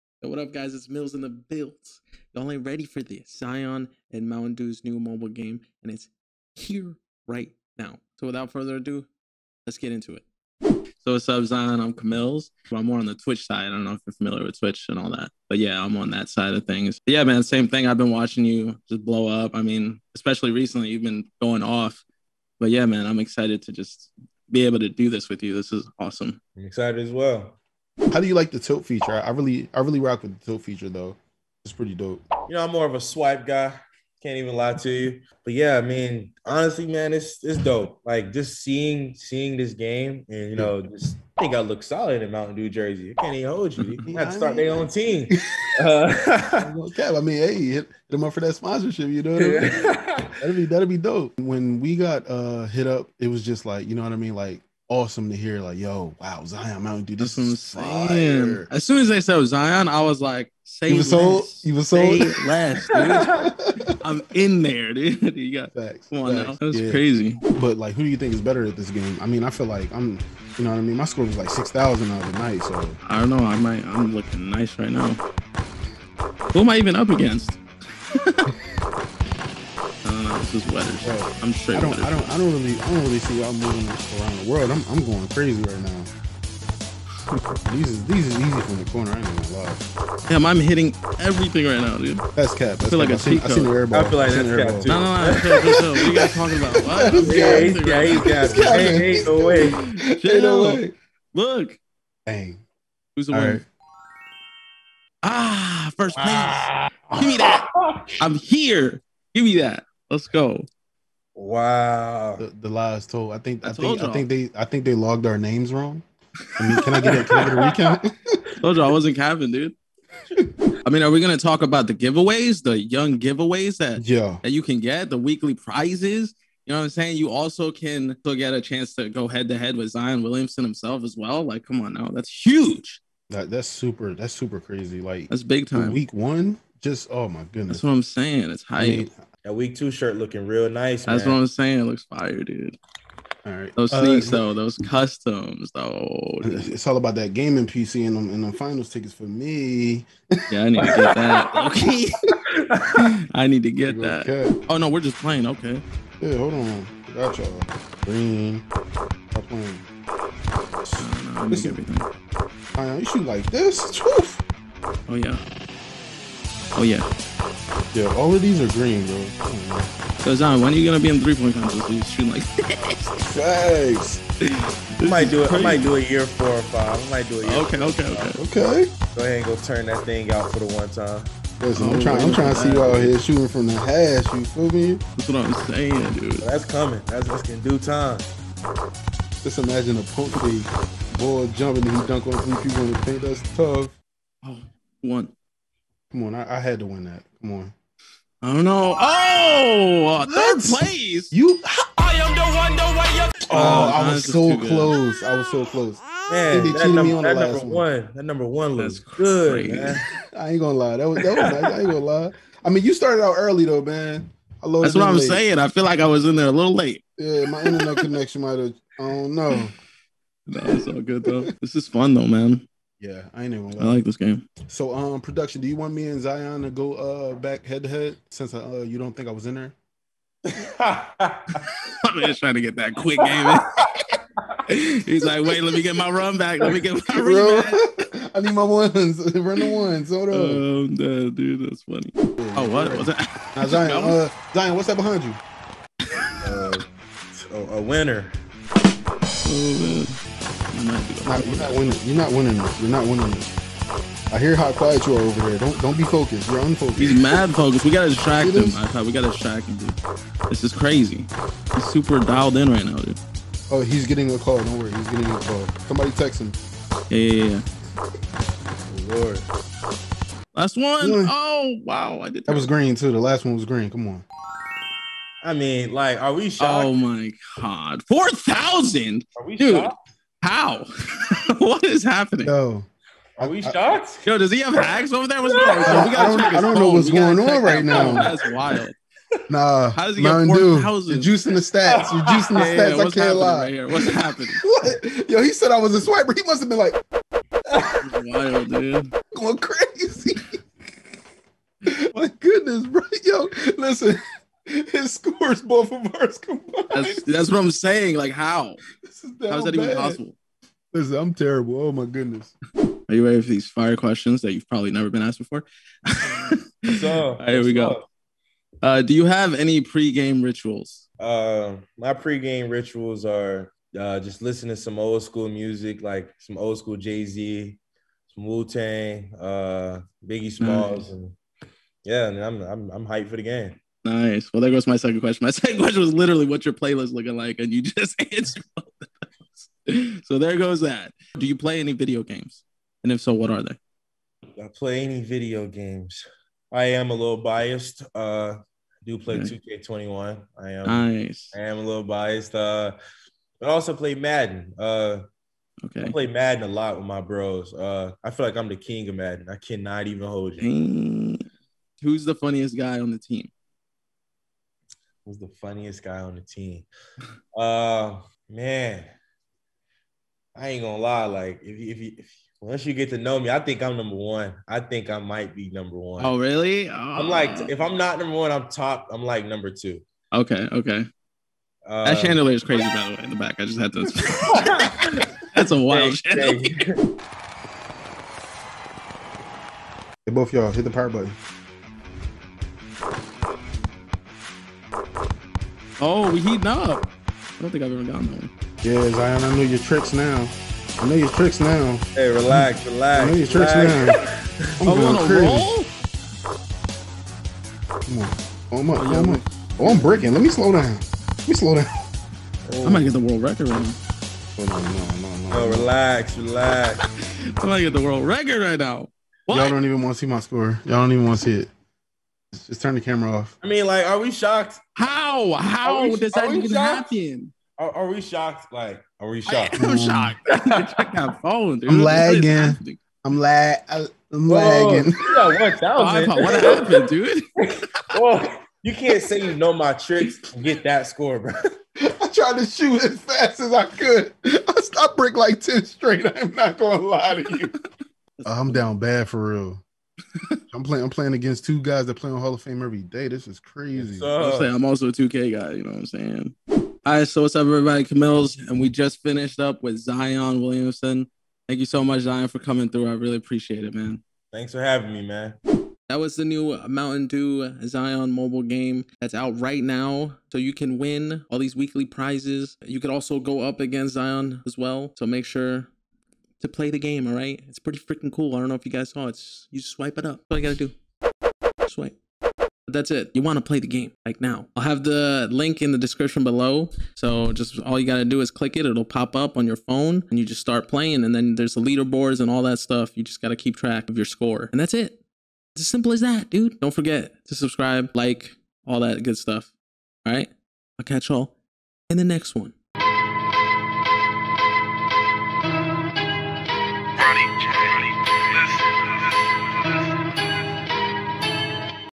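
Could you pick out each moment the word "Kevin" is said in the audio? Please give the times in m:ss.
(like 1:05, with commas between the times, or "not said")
1:59.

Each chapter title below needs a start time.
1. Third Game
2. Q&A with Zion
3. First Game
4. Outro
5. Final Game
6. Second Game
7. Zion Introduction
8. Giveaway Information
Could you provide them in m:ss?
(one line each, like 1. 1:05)
1. 4:02
2. 5:13
3. 1:07
4. 7:37
5. 6:27
6. 2:35
7. 0:10
8. 2:00.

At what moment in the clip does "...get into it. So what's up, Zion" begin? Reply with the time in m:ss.
0:09.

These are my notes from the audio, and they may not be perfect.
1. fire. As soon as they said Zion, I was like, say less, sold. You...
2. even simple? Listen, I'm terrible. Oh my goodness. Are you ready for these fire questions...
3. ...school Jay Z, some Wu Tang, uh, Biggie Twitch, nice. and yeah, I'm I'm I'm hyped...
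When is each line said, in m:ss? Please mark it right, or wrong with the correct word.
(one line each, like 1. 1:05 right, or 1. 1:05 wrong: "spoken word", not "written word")
1. 0:58 right
2. 5:09 wrong: "possible", not "simple"
3. 5:26 wrong: "Smalls", not "Twitch".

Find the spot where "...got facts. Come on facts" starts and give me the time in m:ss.
1:05.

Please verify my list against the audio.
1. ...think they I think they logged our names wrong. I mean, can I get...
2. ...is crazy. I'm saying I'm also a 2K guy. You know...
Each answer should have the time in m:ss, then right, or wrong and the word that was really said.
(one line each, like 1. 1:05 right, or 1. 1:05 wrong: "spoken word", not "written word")
1. 1:54 right
2. 7:33 right.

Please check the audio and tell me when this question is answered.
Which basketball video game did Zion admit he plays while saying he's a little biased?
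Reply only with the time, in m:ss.
5:49.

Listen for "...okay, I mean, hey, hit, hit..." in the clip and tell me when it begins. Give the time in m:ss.
0:46.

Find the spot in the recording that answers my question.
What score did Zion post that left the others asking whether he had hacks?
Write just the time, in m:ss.
4:38.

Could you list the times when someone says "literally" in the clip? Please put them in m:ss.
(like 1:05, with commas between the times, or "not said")
5:36.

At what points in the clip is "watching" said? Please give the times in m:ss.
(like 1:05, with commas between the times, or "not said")
0:18.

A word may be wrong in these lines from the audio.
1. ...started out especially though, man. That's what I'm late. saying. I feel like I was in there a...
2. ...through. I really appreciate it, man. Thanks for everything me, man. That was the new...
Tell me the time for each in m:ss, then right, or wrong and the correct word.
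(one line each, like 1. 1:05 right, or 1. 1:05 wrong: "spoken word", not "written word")
1. 3:32 wrong: "early", not "especially"
2. 7:42 wrong: "having", not "everything".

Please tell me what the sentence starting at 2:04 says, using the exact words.
that you can get, the weekly prizes?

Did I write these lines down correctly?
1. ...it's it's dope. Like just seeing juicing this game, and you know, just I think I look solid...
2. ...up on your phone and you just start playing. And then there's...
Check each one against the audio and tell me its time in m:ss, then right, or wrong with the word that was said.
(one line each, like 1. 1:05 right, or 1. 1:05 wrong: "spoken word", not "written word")
1. 0:37 wrong: "seeing", not "juicing"
2. 8:09 right.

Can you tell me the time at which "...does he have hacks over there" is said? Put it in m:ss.
4:44.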